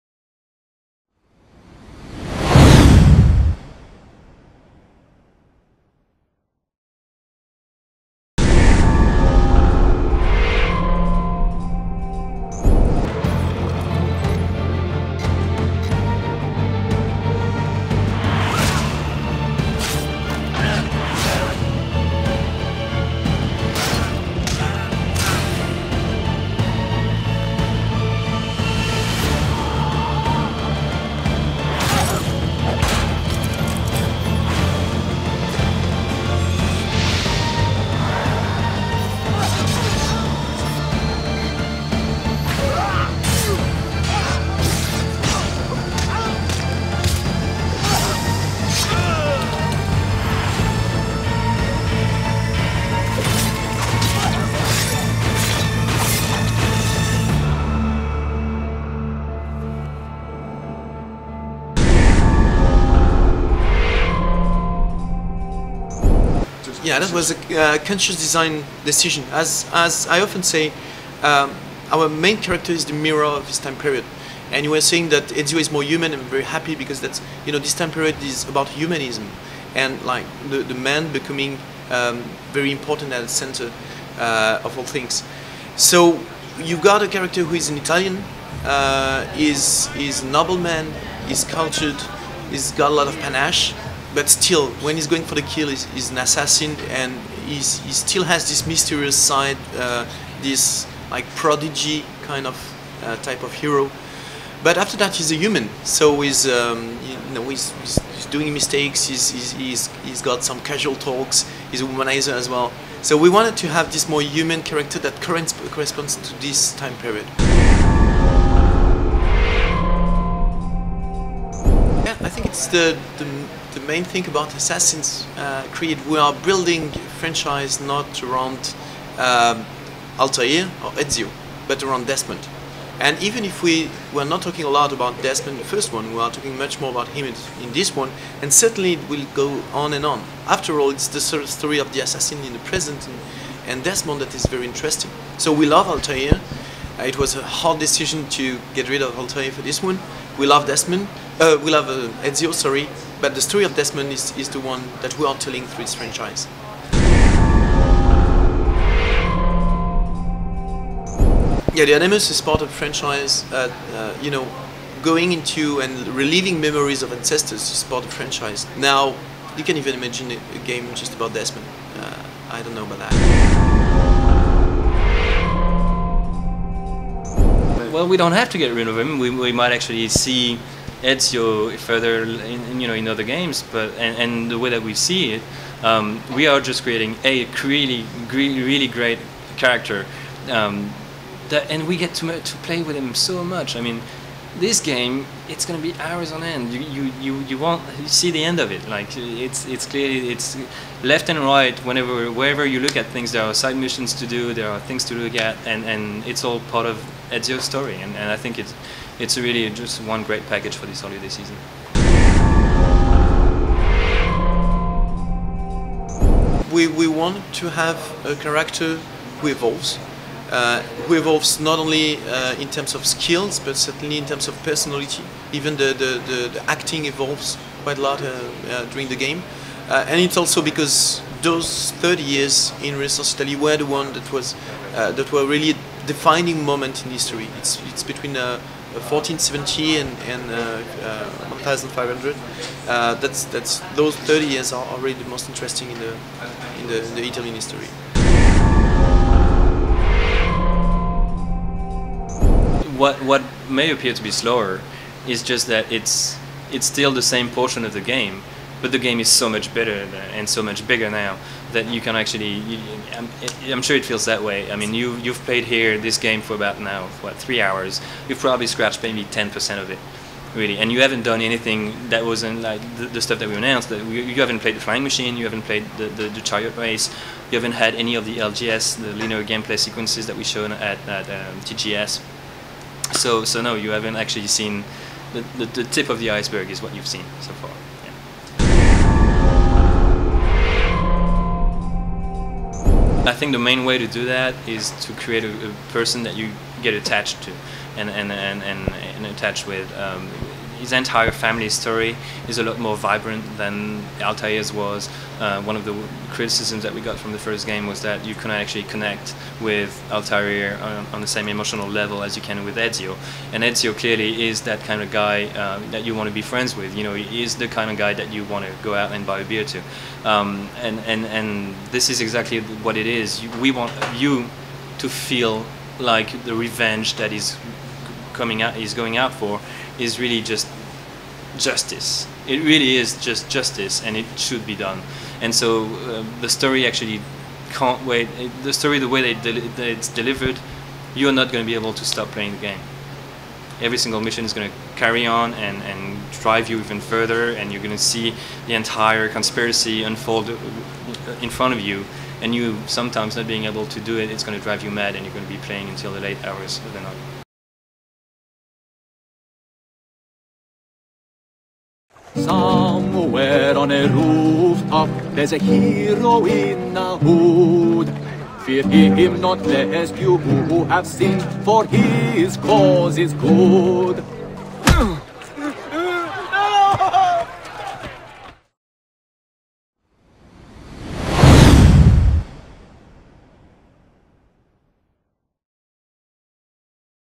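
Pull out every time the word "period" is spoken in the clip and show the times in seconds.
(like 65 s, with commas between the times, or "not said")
73 s, 77 s, 116 s.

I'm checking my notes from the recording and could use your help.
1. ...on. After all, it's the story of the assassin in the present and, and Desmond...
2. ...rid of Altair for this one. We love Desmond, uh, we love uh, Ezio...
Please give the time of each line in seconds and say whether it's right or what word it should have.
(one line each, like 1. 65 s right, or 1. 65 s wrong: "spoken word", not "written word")
1. 140 s right
2. 148 s right.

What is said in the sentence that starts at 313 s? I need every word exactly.
And Ezio clearly is that kind of guy uh, that you want to be friends with.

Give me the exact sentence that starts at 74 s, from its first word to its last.
And you were saying that Ezio is more human.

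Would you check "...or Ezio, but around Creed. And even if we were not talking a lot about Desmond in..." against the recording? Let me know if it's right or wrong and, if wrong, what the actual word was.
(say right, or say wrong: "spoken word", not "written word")
wrong: "Desmond", not "Creed".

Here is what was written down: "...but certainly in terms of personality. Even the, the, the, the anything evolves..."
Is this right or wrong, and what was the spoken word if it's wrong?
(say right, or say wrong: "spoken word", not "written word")
wrong: "acting", not "anything".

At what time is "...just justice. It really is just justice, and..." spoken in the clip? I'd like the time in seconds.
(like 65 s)
330 s.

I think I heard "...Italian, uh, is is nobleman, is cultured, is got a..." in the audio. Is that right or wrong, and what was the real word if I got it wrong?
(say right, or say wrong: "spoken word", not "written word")
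right.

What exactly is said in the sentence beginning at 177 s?
well, we don't have to get rid of him.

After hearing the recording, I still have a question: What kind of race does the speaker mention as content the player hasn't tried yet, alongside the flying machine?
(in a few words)
chariot race.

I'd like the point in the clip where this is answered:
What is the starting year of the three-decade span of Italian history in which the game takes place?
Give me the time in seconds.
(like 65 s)
238 s.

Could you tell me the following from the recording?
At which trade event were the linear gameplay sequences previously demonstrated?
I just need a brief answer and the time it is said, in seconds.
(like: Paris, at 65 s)
TGS, at 281 s.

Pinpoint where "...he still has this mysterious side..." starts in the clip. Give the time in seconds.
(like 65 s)
97 s.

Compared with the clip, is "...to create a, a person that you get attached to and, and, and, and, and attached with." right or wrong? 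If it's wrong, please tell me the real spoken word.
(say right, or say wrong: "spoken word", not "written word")
right.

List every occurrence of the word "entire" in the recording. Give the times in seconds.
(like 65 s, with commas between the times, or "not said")
300 s, 348 s.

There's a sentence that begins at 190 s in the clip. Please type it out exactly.
Um, that, and we get to, to play with him so much.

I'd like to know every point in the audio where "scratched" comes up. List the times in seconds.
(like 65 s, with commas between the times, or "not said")
268 s.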